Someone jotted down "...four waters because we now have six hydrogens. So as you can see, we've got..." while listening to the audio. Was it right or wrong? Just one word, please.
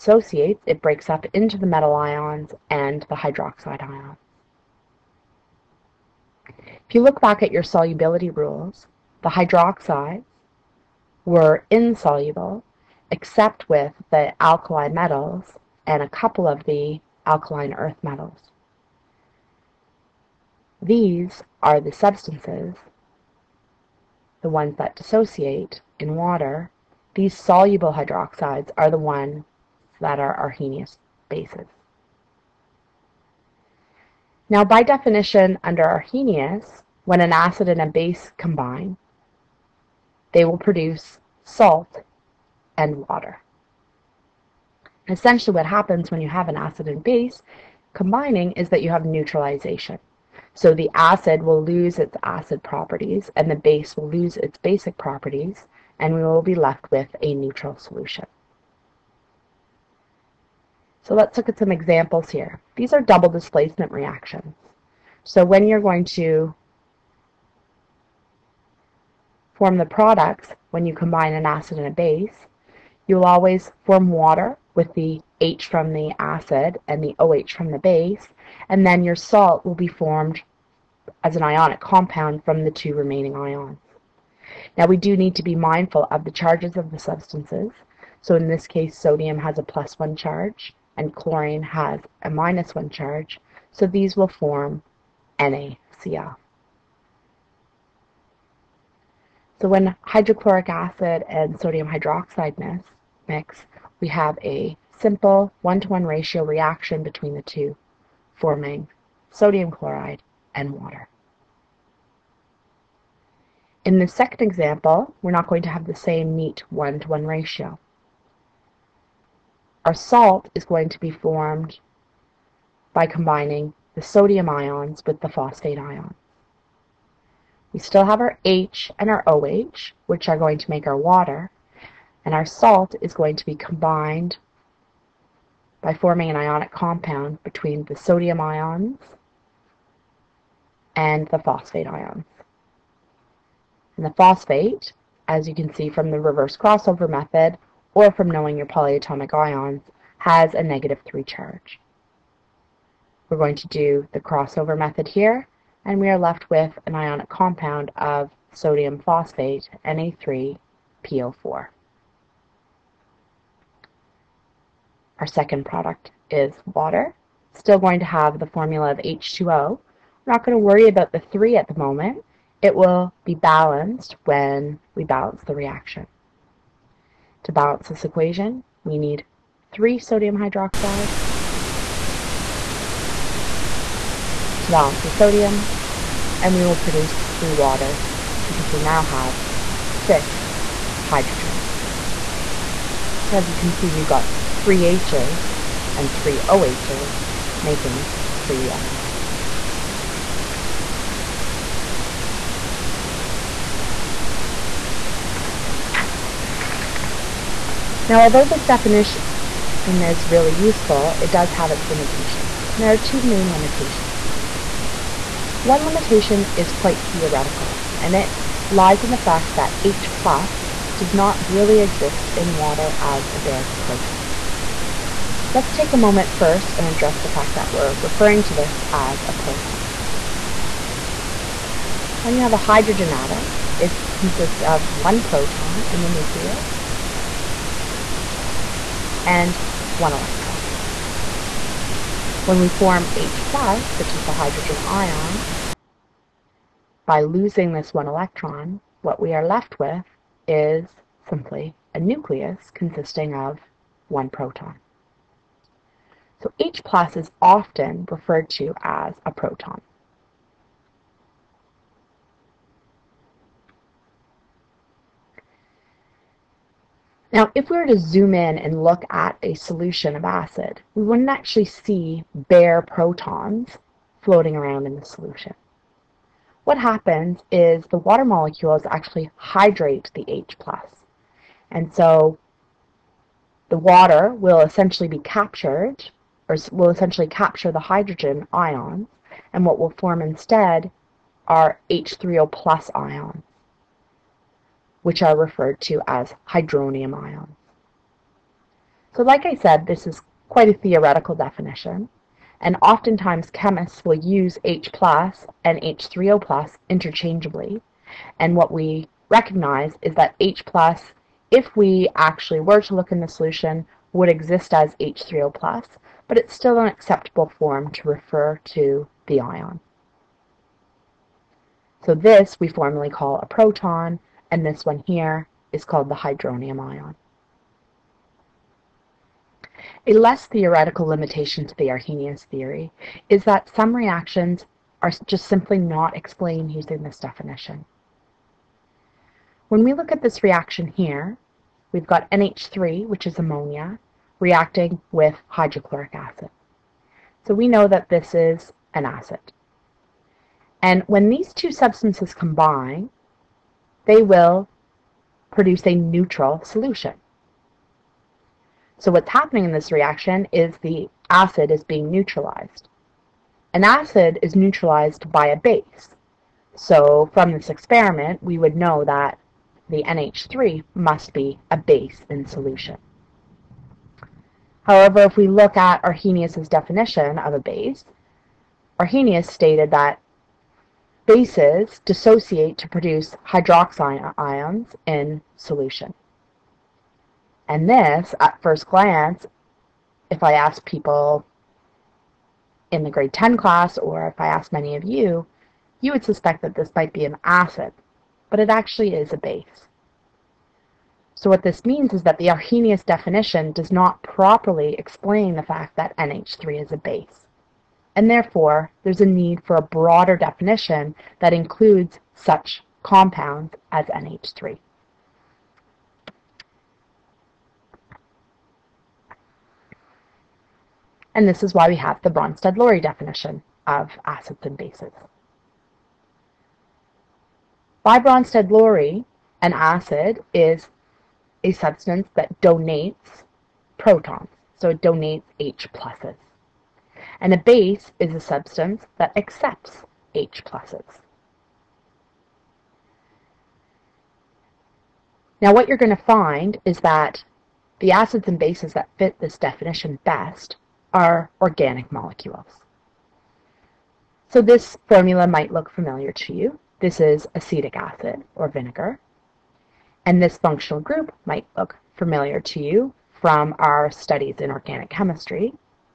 wrong.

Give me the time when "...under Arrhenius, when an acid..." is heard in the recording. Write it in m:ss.
0:35.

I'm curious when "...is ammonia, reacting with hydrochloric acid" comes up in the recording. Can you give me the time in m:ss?
5:43.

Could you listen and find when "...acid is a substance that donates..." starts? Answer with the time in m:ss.
7:09.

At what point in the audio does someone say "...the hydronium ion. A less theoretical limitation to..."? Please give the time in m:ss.
5:26.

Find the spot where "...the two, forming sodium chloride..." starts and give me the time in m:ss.
1:47.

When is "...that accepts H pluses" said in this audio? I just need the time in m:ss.
7:19.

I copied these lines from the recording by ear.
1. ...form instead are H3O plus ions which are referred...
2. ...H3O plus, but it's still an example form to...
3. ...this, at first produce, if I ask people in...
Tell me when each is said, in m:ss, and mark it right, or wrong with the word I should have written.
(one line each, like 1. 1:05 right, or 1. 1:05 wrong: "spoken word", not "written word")
1. 4:49 right
2. 5:14 wrong: "acceptable", not "example"
3. 6:27 wrong: "glance", not "produce".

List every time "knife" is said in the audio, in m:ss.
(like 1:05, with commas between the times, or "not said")
not said.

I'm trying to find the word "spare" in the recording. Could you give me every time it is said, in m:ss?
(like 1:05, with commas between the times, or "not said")
not said.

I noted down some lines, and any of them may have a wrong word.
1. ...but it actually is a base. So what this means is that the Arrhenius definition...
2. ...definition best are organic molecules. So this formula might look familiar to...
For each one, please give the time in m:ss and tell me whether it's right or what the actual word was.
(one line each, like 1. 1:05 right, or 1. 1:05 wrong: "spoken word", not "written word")
1. 6:38 right
2. 7:29 right.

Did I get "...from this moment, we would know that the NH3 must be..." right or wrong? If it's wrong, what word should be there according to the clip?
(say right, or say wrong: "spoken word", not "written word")
wrong: "experiment", not "moment".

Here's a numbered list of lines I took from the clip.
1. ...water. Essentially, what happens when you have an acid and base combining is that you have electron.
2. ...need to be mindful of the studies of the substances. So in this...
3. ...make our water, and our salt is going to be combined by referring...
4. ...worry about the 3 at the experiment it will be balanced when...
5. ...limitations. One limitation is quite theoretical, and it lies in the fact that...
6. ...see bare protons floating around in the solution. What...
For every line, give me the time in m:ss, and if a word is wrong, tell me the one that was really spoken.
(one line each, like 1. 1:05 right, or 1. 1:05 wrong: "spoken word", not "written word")
1. 0:43 wrong: "neutralization", not "electron"
2. 1:25 wrong: "charges", not "studies"
3. 2:10 wrong: "forming", not "referring"
4. 2:50 wrong: "moment", not "experiment"
5. 3:33 right
6. 4:31 right.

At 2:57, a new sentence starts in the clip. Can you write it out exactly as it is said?
To balance this equation, we need three sodium hydroxides.